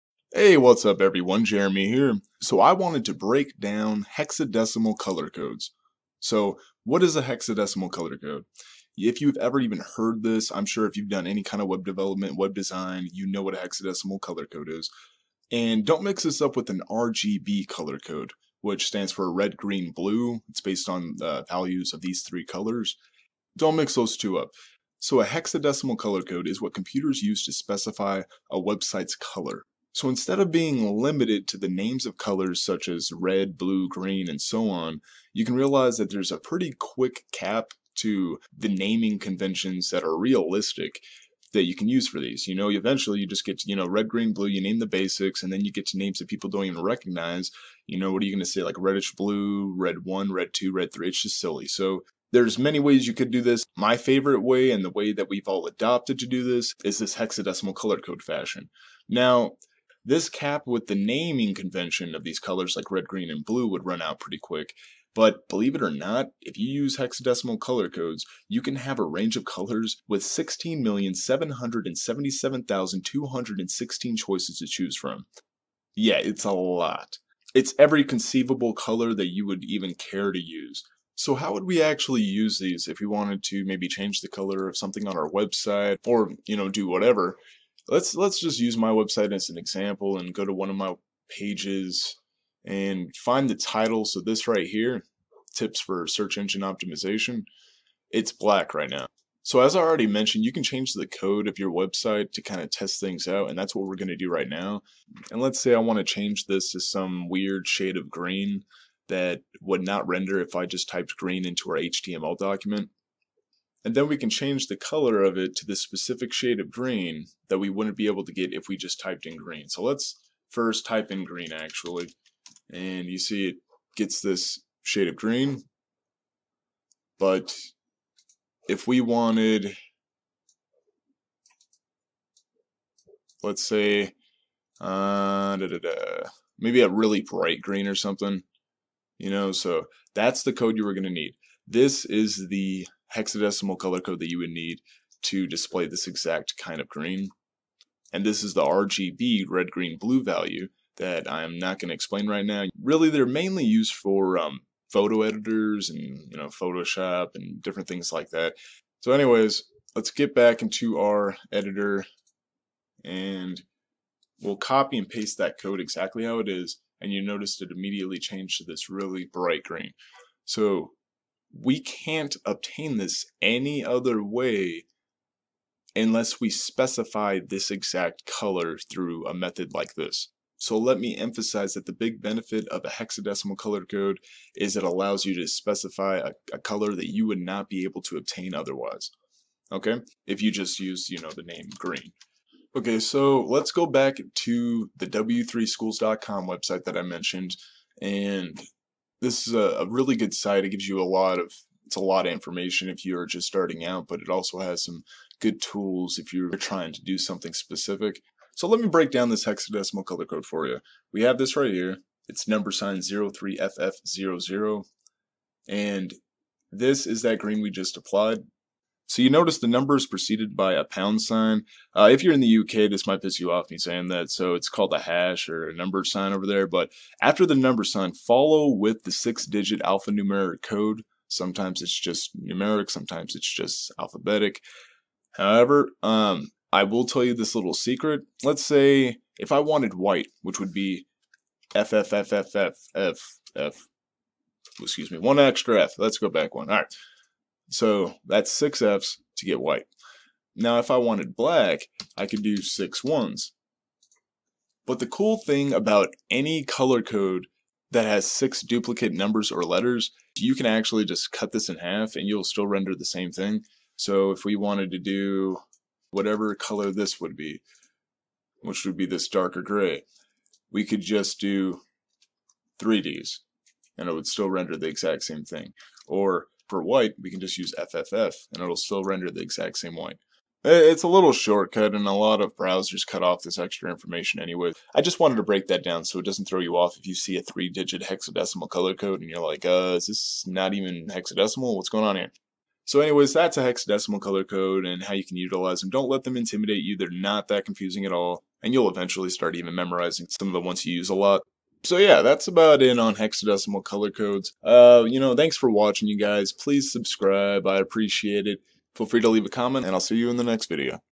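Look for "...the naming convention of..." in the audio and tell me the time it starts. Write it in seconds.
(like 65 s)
60 s.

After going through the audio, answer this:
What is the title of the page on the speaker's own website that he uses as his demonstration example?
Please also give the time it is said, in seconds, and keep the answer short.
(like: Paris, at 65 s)
Tips for search engine optimization, at 95 s.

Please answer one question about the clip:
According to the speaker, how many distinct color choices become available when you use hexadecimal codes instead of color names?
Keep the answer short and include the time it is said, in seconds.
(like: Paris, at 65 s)
16,777,216, at 70 s.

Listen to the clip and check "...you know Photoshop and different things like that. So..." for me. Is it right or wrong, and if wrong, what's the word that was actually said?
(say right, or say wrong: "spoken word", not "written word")
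right.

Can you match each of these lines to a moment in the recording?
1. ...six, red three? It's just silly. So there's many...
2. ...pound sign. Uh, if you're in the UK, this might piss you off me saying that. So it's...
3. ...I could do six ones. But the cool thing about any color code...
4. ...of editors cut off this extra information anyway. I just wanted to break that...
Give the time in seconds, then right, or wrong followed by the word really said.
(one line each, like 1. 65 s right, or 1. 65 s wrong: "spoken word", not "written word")
1. 50 s wrong: "two", not "six"
2. 220 s right
3. 252 s right
4. 282 s wrong: "browsers", not "editors".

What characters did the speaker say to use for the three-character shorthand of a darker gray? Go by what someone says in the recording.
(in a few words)
3Ds.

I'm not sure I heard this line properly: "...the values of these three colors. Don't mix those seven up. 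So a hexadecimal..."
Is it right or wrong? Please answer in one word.
wrong.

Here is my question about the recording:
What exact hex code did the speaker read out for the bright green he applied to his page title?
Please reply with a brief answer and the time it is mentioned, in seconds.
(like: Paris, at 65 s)
#03FF00, at 212 s.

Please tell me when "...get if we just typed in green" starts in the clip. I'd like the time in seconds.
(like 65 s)
118 s.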